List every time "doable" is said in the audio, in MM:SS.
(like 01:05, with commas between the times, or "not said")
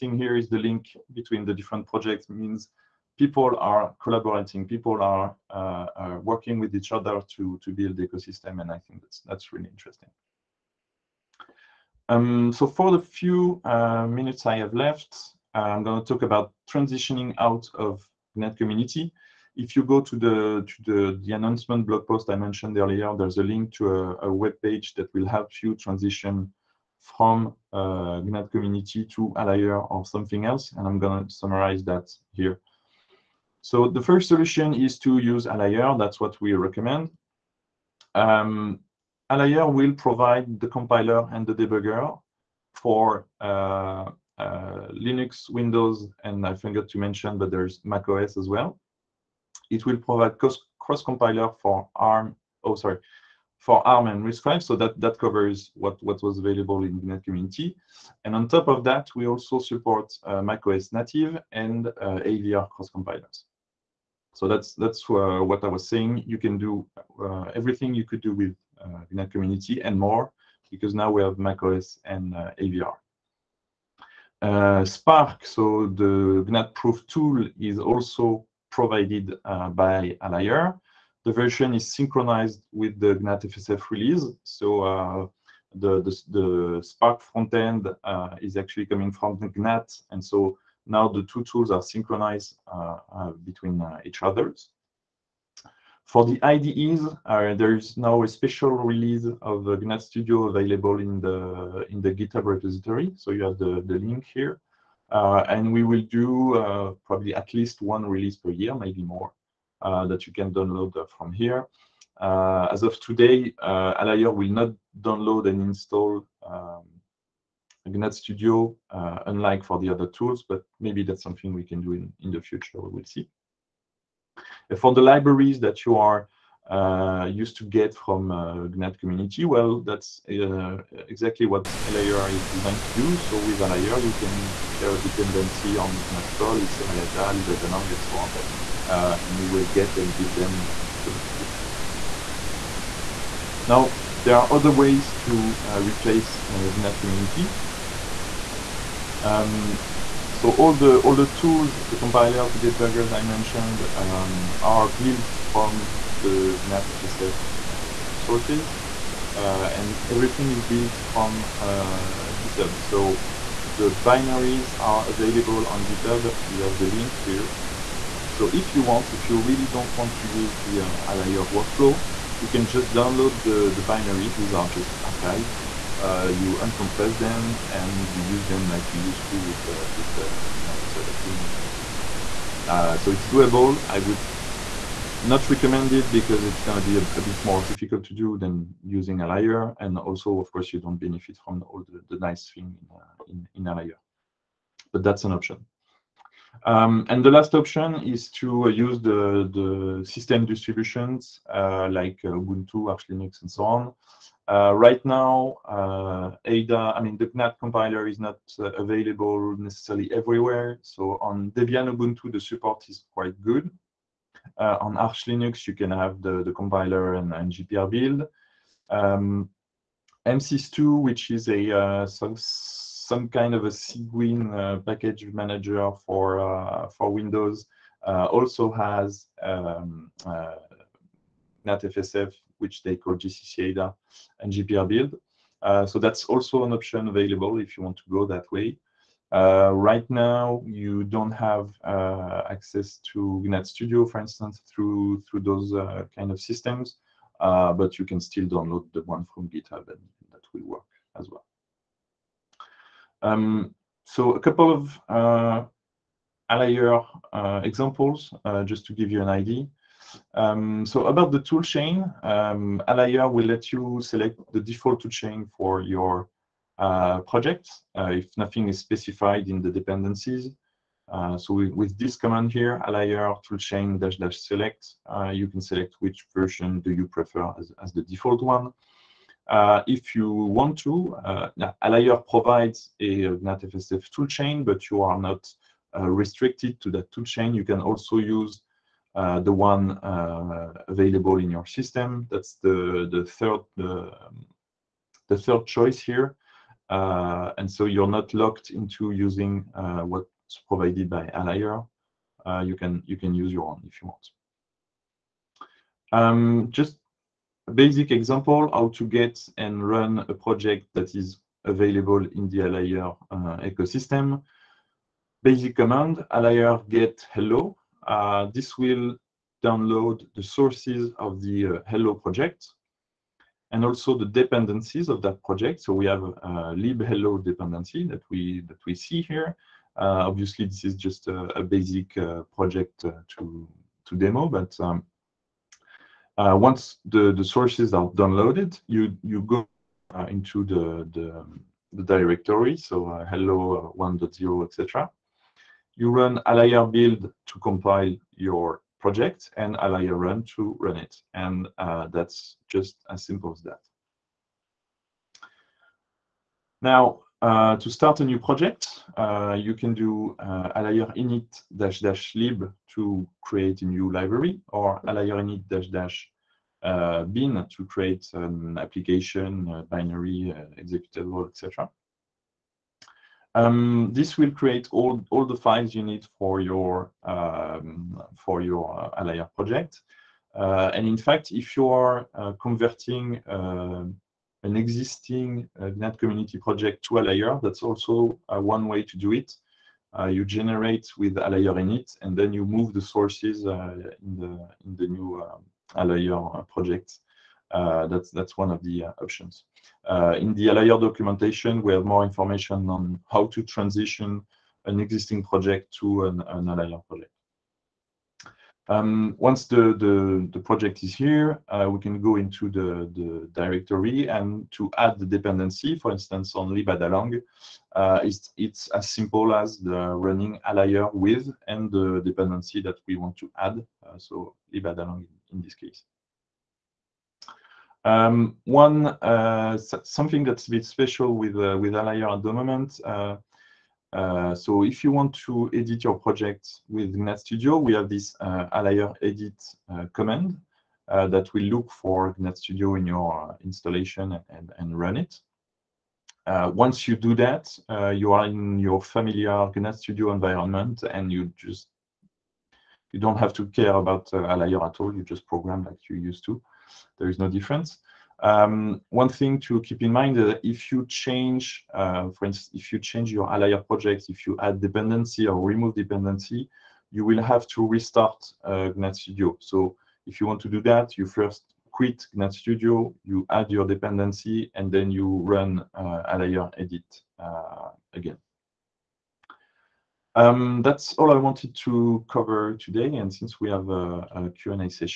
03:03.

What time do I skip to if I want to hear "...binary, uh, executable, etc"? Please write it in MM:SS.
06:09.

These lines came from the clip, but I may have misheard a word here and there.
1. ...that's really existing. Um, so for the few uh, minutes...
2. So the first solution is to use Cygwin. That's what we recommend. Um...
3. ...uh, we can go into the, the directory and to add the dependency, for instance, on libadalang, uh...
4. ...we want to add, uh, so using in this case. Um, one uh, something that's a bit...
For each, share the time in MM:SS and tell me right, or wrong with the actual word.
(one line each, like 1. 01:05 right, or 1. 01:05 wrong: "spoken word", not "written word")
1. 00:09 wrong: "interesting", not "existing"
2. 00:33 wrong: "Alire", not "Cygwin"
3. 06:51 right
4. 07:03 wrong: "libadalang", not "using".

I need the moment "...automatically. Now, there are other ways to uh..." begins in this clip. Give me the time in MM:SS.
02:20.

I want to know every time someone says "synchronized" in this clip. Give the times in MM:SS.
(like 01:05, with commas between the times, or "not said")
01:21, 01:31.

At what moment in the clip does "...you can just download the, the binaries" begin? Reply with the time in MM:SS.
02:52.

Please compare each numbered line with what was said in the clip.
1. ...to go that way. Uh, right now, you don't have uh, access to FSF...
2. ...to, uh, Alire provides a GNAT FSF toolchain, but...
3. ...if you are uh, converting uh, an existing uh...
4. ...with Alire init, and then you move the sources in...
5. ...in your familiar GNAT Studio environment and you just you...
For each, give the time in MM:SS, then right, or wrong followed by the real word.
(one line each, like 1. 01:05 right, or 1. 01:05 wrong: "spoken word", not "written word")
1. 03:57 wrong: "GNAT", not "FSF"
2. 04:40 right
3. 06:21 right
4. 06:31 right
5. 07:28 right.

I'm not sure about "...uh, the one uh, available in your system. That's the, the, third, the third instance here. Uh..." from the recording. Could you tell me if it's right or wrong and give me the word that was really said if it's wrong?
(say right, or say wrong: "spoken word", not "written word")
wrong: "choice", not "instance".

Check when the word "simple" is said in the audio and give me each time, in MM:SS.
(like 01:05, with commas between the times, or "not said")
05:53, 06:59.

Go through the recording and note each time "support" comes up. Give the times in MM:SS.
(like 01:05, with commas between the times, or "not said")
00:59, 03:32.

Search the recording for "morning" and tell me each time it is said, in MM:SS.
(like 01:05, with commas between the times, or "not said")
not said.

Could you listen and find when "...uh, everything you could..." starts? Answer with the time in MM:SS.
01:07.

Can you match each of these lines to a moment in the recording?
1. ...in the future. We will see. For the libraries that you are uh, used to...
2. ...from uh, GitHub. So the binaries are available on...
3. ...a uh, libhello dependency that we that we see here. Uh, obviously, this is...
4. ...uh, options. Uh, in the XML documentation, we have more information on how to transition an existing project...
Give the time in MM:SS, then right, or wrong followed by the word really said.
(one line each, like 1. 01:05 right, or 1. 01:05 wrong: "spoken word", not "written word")
1. 02:02 right
2. 02:41 right
3. 05:26 right
4. 06:39 wrong: "Alire", not "XML".